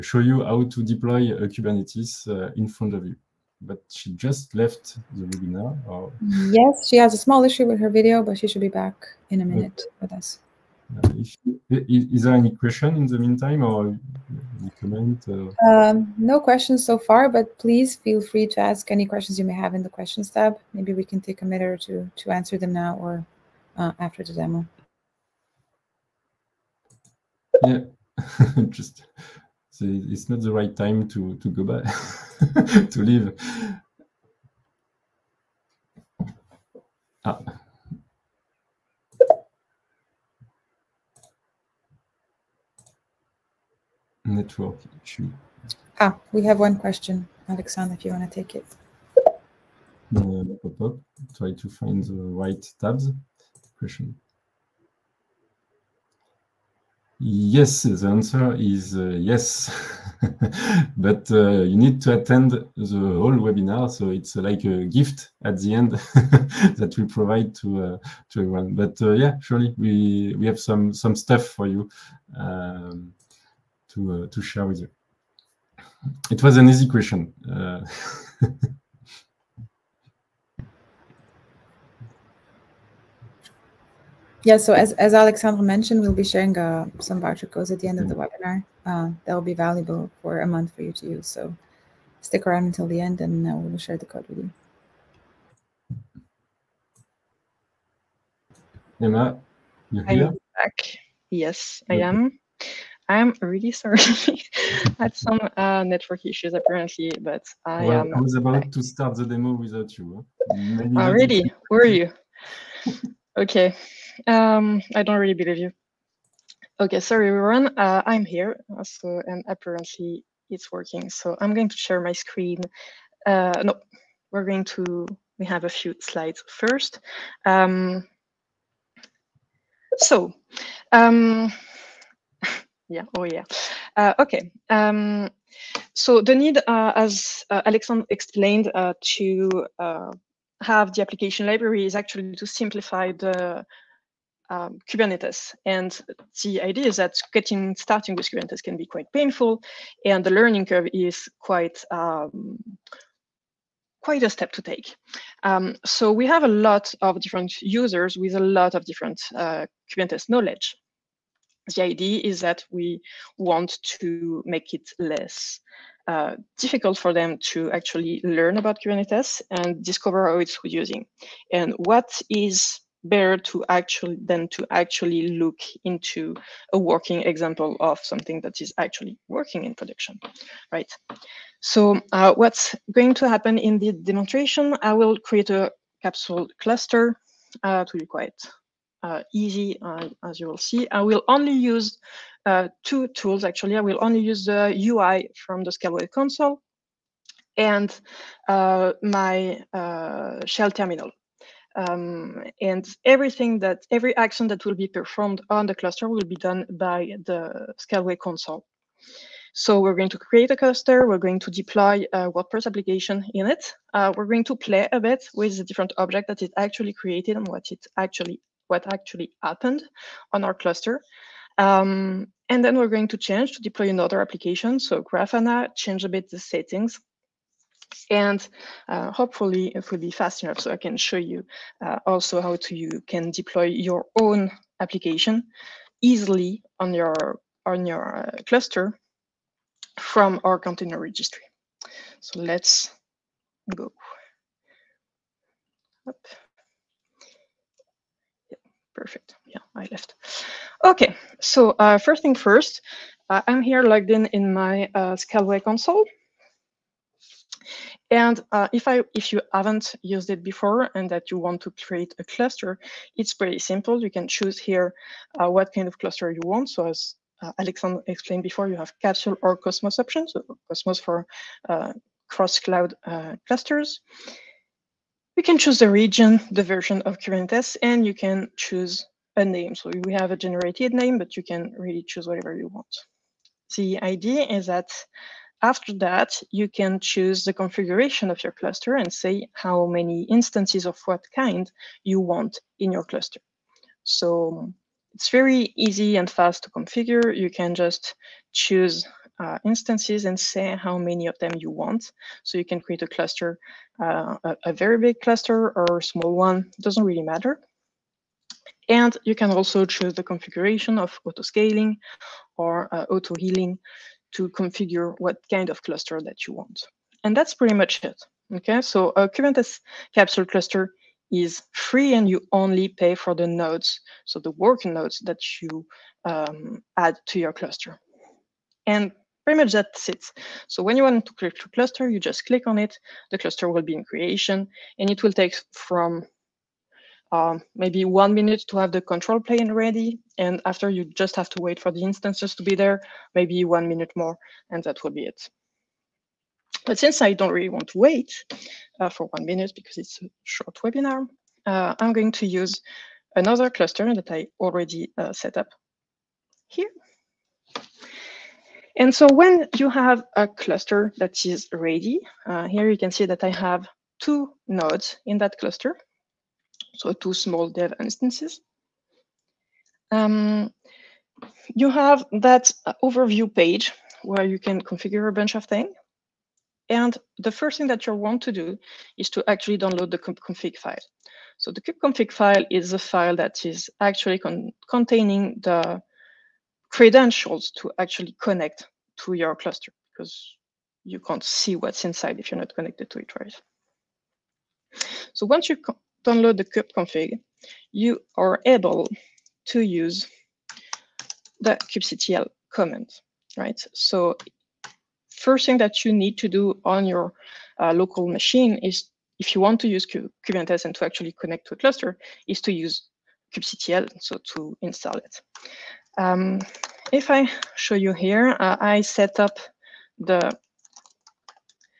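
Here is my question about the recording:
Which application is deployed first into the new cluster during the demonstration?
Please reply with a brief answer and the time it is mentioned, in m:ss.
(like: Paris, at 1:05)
WordPress, at 3:32.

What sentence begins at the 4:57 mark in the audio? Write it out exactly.
You can just choose uh, instances and say how many of them you want.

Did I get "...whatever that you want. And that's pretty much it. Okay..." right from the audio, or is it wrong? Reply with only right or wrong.
wrong.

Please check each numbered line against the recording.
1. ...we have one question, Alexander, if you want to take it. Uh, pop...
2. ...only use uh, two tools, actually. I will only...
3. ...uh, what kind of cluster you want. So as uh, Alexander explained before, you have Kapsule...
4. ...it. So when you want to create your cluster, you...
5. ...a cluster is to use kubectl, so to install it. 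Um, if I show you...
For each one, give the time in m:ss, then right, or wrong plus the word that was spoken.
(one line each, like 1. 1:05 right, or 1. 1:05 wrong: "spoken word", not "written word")
1. 0:46 right
2. 3:11 right
3. 4:25 right
4. 5:30 right
5. 6:51 right.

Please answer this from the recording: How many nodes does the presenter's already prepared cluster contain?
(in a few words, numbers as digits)
2.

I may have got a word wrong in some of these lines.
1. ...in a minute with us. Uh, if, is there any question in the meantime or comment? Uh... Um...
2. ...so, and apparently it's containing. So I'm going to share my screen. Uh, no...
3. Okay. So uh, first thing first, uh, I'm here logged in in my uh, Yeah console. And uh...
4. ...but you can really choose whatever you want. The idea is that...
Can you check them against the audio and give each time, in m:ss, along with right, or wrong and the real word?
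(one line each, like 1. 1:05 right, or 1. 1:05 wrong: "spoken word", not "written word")
1. 0:09 right
2. 1:58 wrong: "working", not "containing"
3. 4:10 wrong: "Scaleway", not "Yeah"
4. 4:41 right.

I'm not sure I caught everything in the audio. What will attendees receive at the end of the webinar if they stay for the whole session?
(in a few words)
voucher codes.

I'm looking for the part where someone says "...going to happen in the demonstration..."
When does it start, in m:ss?
3:02.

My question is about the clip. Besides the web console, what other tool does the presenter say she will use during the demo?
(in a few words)
shell terminal.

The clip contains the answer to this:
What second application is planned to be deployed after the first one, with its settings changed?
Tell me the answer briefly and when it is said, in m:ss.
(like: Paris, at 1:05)
Grafana, at 3:45.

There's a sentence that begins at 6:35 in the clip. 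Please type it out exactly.
So once you download the kubeconfig, you are able to use the kubectl command, right?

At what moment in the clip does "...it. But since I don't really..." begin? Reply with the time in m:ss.
5:45.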